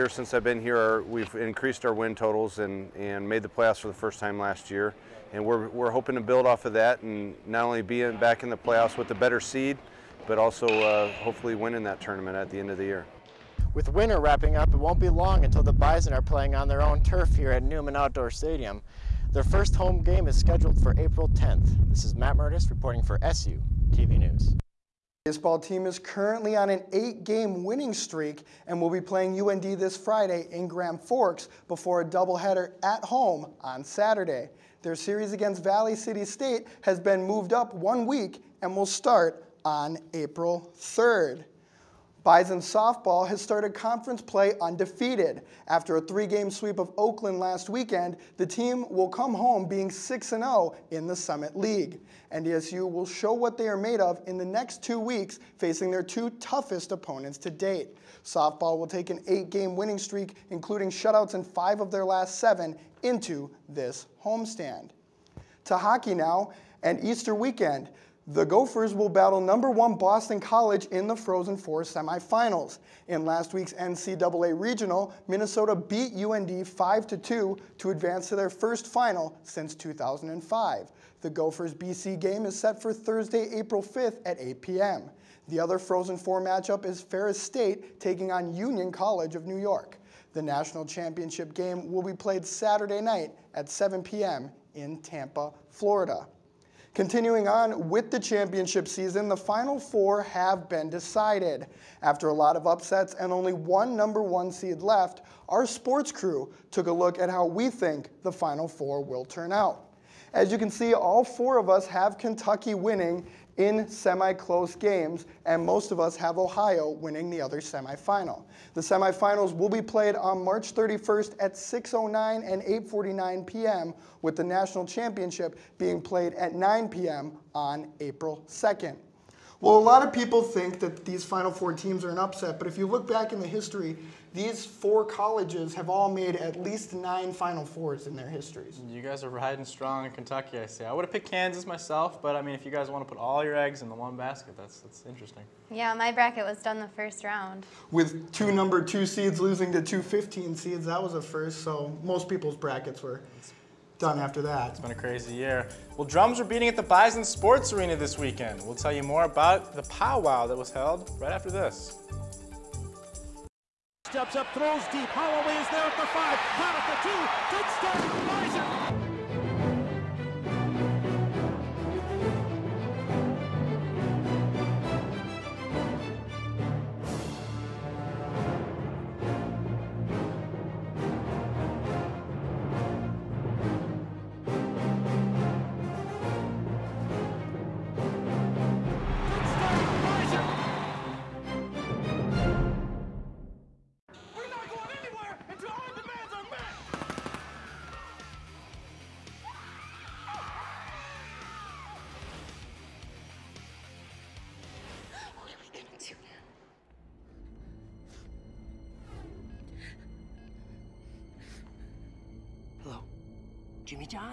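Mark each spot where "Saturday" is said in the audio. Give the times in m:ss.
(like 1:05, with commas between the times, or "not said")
0:33, 1:32.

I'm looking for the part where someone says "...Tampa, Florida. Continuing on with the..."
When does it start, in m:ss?
1:34.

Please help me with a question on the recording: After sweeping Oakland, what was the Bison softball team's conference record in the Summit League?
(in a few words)
6-0.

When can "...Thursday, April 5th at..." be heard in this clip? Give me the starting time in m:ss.
1:22.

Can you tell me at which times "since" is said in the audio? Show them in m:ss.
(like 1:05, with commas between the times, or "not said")
0:00, 1:19.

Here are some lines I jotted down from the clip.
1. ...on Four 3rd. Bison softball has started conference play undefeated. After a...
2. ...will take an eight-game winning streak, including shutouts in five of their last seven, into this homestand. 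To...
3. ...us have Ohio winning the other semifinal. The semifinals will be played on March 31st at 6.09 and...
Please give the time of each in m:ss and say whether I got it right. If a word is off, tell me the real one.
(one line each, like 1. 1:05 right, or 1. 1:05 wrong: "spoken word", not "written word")
1. 0:39 wrong: "April", not "Four"
2. 0:58 right
3. 1:55 right.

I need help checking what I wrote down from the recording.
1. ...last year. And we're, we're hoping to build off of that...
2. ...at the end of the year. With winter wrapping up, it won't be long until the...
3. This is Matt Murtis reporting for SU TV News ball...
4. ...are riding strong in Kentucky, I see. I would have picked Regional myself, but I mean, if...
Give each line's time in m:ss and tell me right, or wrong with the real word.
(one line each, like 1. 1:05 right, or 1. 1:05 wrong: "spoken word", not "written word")
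1. 0:04 right
2. 0:12 right
3. 0:21 right
4. 2:19 wrong: "Kansas", not "Regional".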